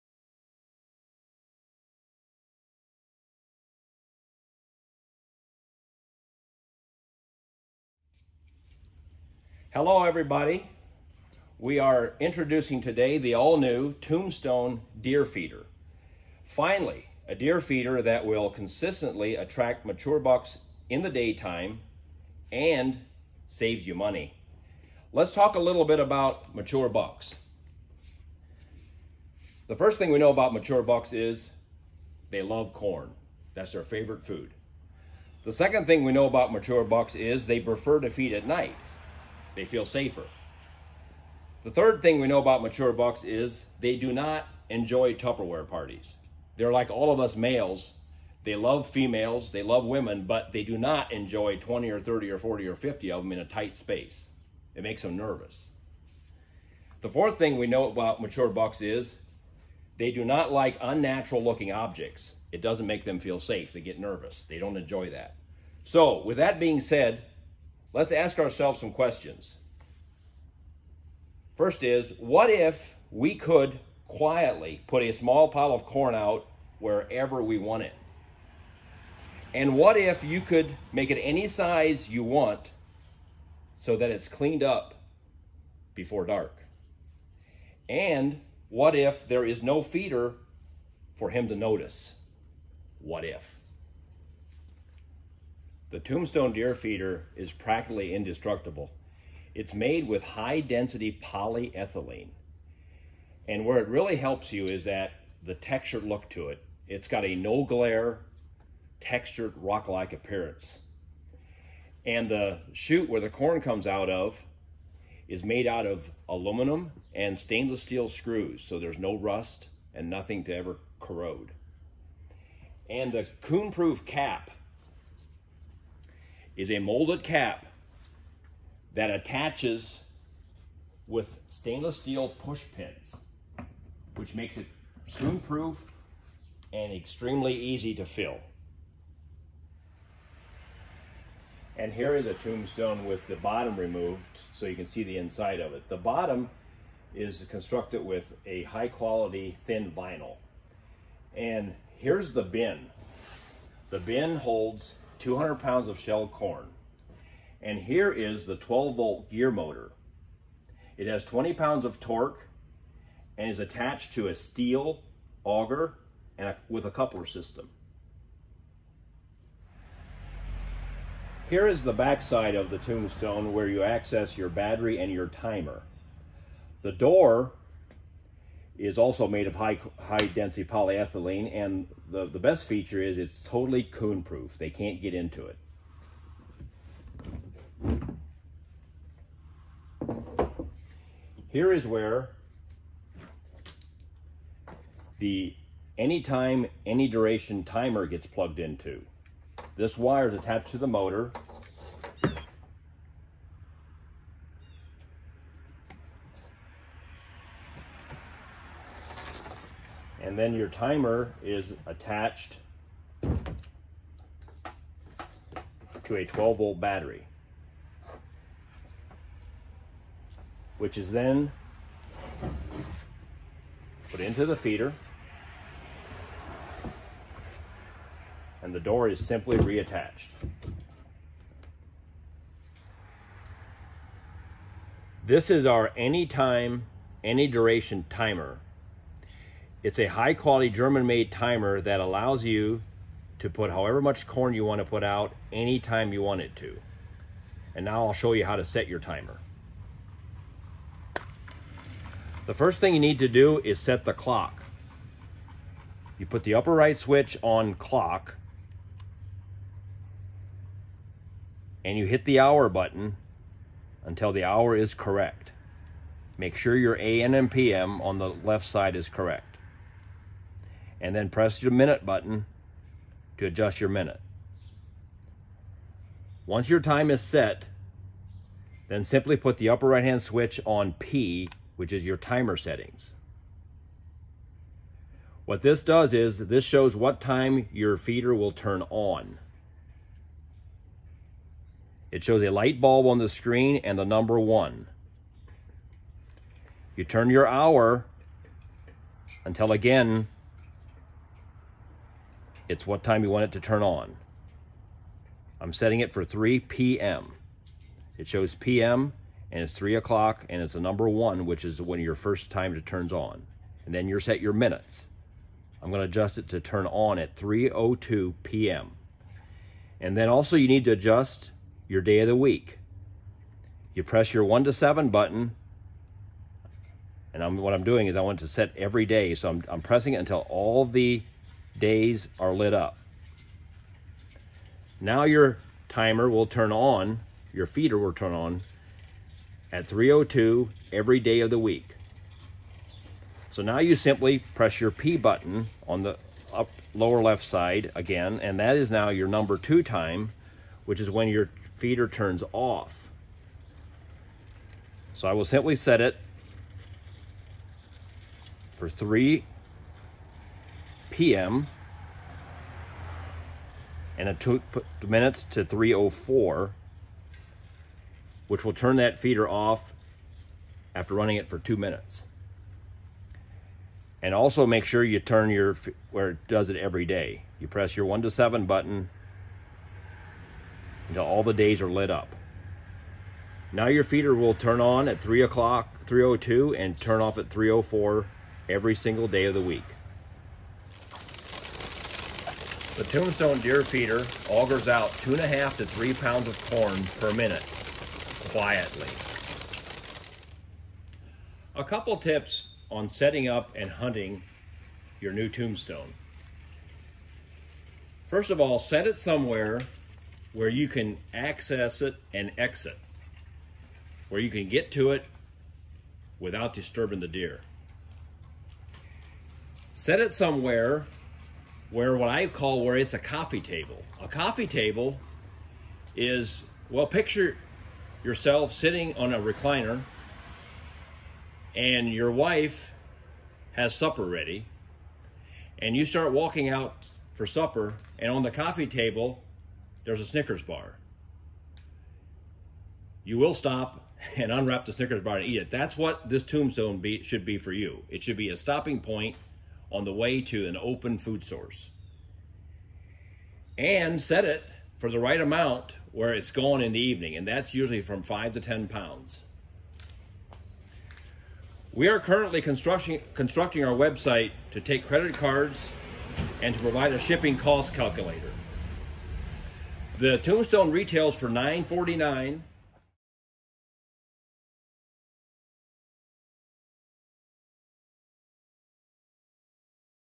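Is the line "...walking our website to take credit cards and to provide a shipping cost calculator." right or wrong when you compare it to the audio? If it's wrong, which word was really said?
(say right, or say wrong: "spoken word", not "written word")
wrong: "constructing", not "walking".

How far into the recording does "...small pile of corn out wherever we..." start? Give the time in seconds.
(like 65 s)
75 s.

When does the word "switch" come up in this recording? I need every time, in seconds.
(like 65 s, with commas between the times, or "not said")
256 s, 280 s.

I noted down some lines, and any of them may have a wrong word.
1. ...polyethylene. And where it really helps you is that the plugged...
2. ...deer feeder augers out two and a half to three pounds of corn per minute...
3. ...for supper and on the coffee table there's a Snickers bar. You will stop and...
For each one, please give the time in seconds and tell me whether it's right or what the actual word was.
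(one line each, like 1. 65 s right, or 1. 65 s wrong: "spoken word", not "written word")
1. 101 s wrong: "textured", not "plugged"
2. 393 s right
3. 437 s right.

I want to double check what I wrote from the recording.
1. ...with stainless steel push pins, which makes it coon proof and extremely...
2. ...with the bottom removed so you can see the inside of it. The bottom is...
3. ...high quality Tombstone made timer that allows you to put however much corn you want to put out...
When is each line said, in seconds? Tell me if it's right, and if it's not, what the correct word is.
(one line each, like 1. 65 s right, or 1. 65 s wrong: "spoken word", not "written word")
1. 131 s right
2. 143 s right
3. 240 s wrong: "German", not "Tombstone".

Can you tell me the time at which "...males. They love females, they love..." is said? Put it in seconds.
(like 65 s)
47 s.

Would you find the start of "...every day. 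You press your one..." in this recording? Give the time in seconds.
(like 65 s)
376 s.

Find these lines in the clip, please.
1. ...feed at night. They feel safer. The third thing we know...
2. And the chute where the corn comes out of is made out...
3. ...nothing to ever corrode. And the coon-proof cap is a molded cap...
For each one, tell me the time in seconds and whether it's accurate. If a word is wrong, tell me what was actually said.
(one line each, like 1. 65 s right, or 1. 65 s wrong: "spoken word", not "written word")
1. 38 s right
2. 112 s right
3. 120 s right.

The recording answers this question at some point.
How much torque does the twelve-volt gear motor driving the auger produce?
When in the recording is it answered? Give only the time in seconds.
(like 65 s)
161 s.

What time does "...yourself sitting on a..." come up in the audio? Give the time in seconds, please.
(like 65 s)
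428 s.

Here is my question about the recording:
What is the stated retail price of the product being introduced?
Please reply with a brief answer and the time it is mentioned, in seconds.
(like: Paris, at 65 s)
$949, at 471 s.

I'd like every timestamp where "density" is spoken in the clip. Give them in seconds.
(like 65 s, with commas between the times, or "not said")
100 s, 180 s.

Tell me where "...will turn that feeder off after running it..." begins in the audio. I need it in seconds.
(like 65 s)
368 s.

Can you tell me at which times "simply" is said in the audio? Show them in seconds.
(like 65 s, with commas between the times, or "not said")
229 s, 279 s, 343 s, 355 s.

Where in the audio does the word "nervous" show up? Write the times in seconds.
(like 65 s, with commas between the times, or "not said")
55 s, 63 s.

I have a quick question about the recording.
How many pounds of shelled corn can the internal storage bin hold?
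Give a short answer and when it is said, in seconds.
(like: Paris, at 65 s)
200 pounds, at 155 s.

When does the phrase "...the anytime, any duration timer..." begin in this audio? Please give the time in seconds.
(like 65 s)
195 s.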